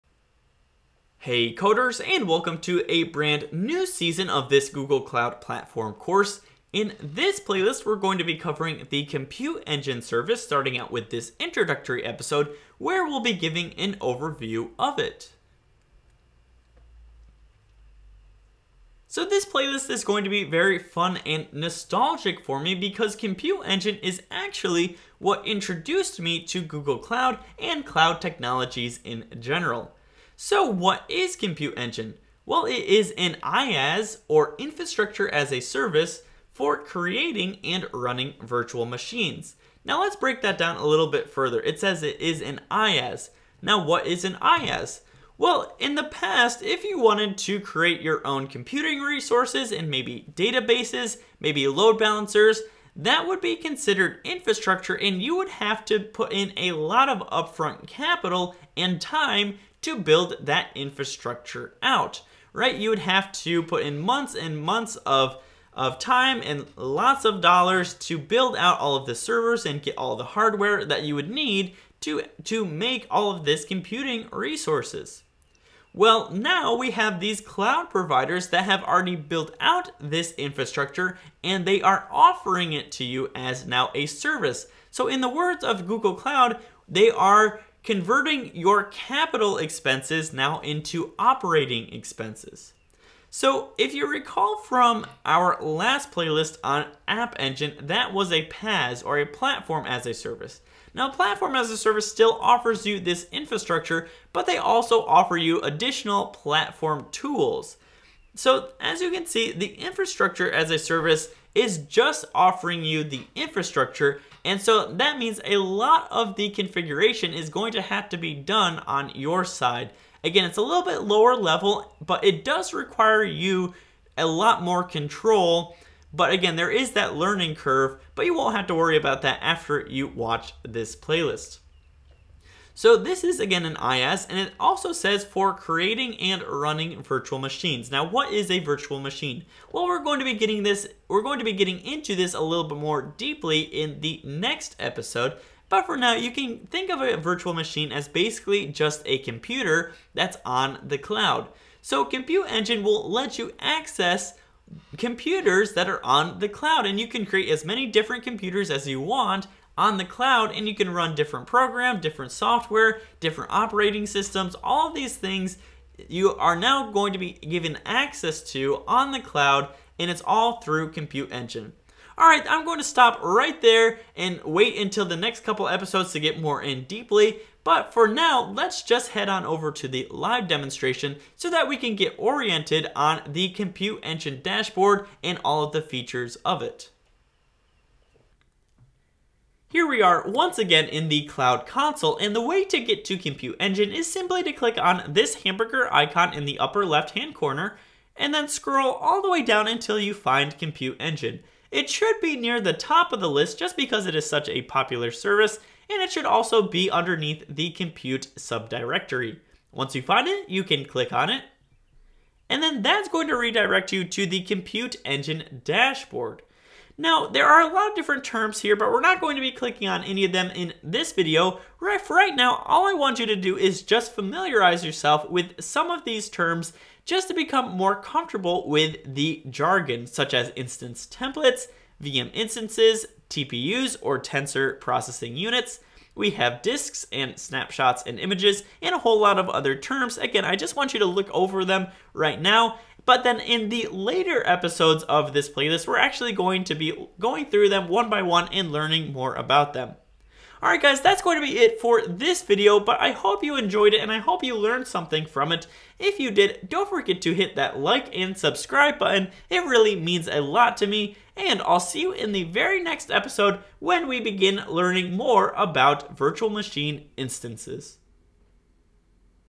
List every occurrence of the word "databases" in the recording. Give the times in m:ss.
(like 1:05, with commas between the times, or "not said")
0:50.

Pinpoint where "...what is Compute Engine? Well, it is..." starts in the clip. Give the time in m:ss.
0:30.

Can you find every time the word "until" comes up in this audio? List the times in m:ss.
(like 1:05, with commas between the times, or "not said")
2:54, 3:19.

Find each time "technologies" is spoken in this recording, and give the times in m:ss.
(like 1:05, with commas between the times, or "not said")
0:28.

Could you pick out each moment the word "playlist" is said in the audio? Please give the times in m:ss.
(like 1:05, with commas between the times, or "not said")
0:07, 0:19, 1:36, 2:10, 4:05.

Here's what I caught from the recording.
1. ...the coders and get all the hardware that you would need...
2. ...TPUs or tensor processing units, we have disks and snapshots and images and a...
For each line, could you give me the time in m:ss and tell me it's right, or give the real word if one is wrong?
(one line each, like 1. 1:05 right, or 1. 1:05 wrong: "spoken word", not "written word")
1. 1:09 wrong: "servers", not "coders"
2. 3:53 right.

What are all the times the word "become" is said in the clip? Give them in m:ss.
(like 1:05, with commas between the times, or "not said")
3:47.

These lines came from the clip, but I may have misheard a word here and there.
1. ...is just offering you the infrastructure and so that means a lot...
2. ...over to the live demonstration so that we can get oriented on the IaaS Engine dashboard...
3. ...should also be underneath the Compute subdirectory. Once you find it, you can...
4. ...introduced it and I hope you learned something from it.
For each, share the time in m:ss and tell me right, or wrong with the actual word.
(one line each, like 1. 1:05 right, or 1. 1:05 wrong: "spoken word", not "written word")
1. 1:51 right
2. 2:59 wrong: "Compute", not "IaaS"
3. 3:26 right
4. 4:13 wrong: "enjoyed", not "introduced".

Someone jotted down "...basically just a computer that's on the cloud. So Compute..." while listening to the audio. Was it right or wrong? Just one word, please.
right.